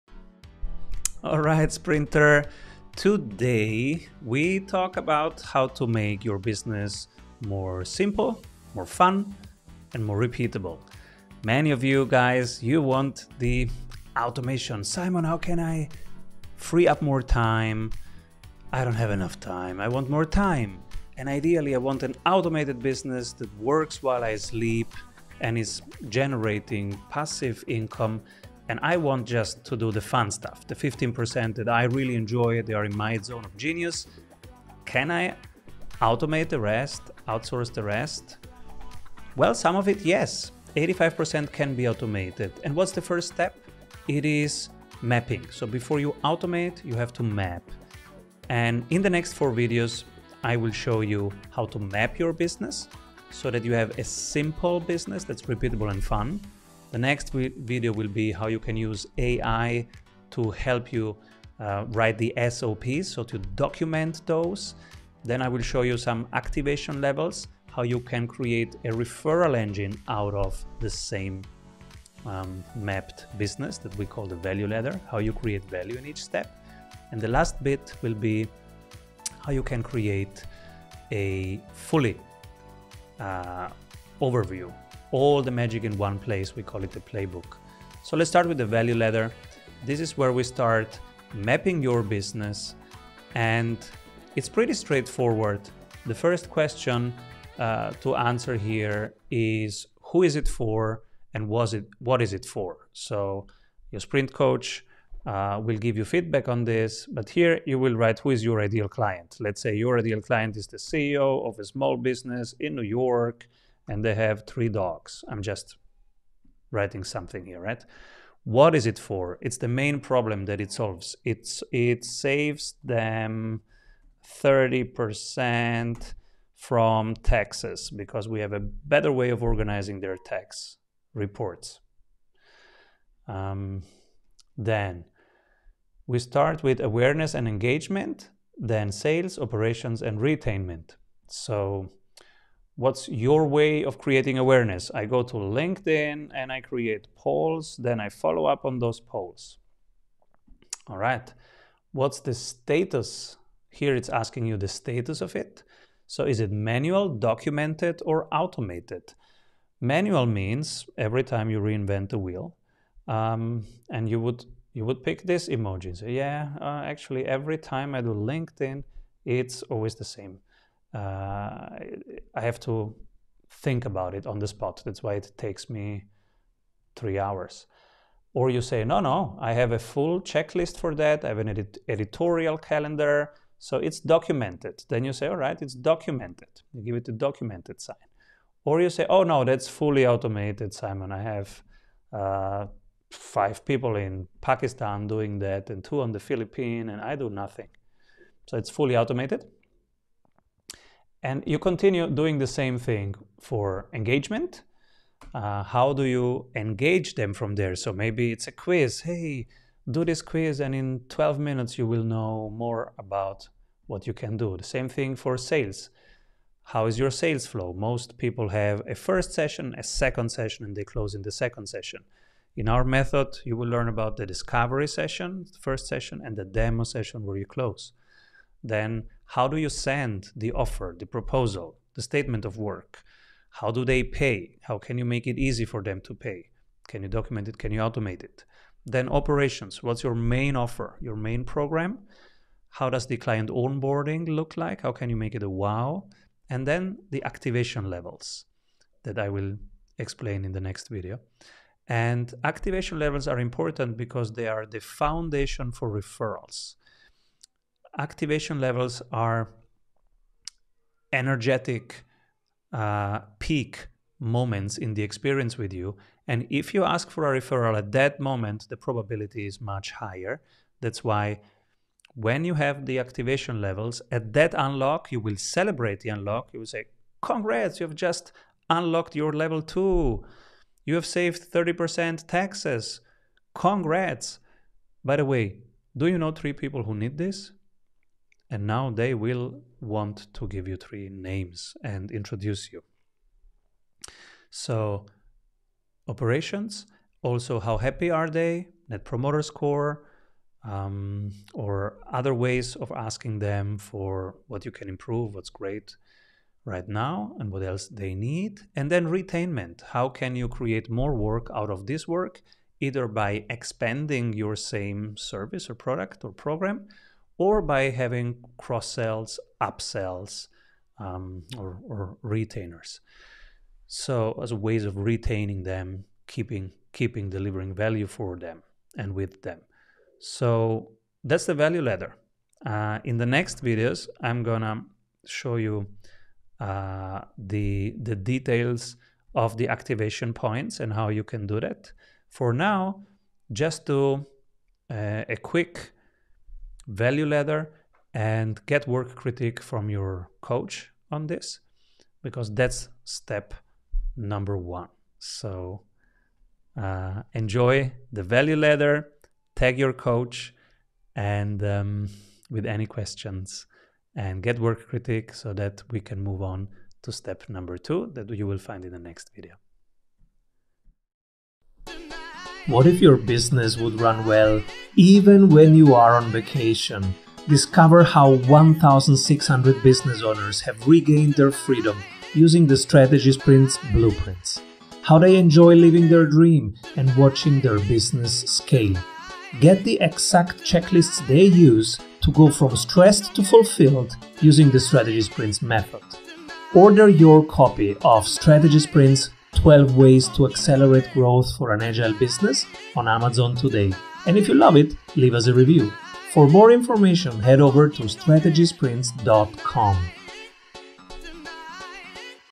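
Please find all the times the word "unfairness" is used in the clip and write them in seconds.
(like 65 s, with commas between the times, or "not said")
not said.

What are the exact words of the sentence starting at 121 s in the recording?
It's it saves them 30% from taxes because we have a better way of organizing their tax reports.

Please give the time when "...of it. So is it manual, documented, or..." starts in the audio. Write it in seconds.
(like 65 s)
155 s.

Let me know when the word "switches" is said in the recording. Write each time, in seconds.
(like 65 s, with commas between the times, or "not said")
not said.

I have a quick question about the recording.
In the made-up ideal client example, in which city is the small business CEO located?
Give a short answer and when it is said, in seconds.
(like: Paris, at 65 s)
New York, at 112 s.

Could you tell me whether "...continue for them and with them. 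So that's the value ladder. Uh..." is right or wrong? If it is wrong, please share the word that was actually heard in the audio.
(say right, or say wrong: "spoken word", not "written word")
wrong: "value", not "continue".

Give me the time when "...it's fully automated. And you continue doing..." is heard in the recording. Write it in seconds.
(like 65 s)
198 s.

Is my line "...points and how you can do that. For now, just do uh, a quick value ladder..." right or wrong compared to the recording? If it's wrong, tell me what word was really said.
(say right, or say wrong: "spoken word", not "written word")
right.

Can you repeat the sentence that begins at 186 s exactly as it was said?
You give it a documented sign.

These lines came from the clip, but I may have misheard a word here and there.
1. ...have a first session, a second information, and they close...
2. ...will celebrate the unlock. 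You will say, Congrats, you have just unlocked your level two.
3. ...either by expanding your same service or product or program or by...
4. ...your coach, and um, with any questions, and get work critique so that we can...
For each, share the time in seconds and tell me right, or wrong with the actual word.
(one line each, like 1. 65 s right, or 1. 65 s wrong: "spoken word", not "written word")
1. 218 s wrong: "session", not "information"
2. 275 s right
3. 312 s right
4. 359 s right.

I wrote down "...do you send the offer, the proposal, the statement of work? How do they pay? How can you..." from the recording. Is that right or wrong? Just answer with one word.
right.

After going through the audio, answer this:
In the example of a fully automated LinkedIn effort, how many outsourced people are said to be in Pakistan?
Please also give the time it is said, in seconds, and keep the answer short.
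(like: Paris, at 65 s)
5, at 193 s.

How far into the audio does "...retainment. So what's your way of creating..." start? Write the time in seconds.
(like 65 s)
140 s.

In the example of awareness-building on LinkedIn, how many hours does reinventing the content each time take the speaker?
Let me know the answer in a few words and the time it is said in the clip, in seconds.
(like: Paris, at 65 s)
3, at 176 s.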